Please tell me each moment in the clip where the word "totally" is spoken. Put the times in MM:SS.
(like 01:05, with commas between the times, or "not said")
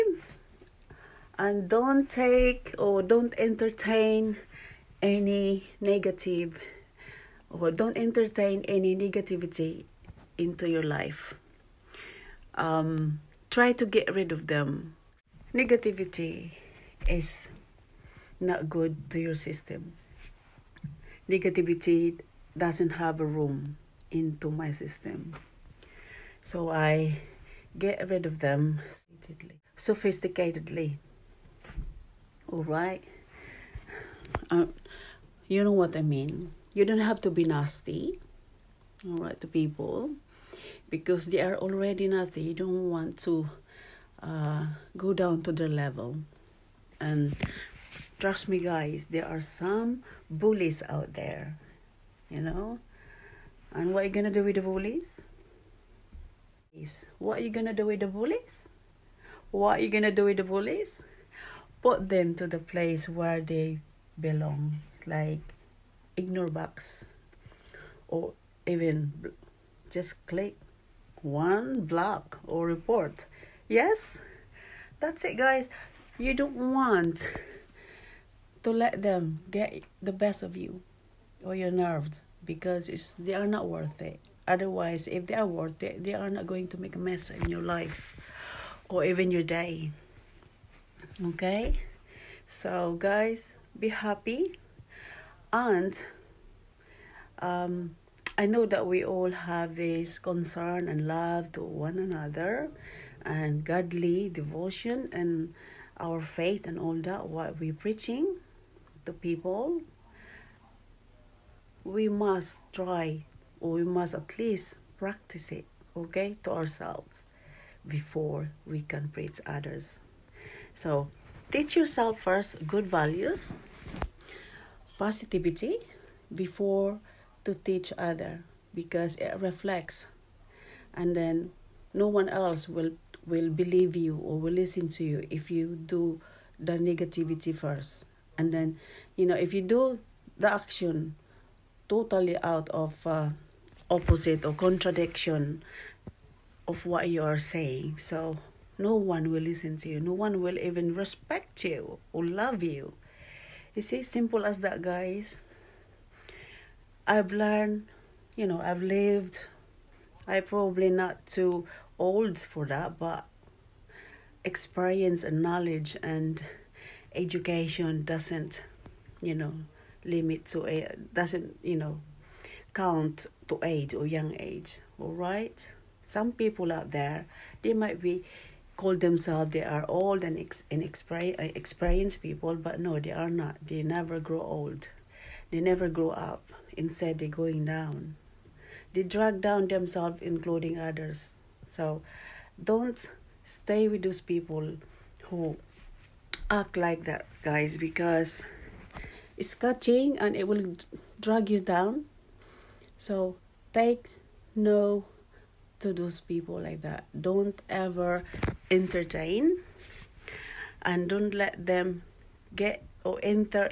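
02:21.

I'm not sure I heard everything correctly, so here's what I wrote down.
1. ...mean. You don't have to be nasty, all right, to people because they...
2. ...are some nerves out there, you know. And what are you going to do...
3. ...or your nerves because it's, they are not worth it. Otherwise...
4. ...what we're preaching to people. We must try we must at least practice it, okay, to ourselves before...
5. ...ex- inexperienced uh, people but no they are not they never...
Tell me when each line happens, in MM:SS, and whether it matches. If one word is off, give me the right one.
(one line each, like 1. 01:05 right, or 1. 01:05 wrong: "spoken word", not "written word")
1. 00:36 right
2. 00:49 wrong: "bullies", not "nerves"
3. 01:21 right
4. 01:47 right
5. 03:00 right.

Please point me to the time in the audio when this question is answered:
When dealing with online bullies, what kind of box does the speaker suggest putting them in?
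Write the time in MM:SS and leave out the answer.
01:06.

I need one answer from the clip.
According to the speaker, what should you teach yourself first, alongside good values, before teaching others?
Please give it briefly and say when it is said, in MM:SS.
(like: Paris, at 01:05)
positivity, at 02:04.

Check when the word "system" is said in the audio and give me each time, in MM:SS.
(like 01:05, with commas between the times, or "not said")
00:19, 00:24.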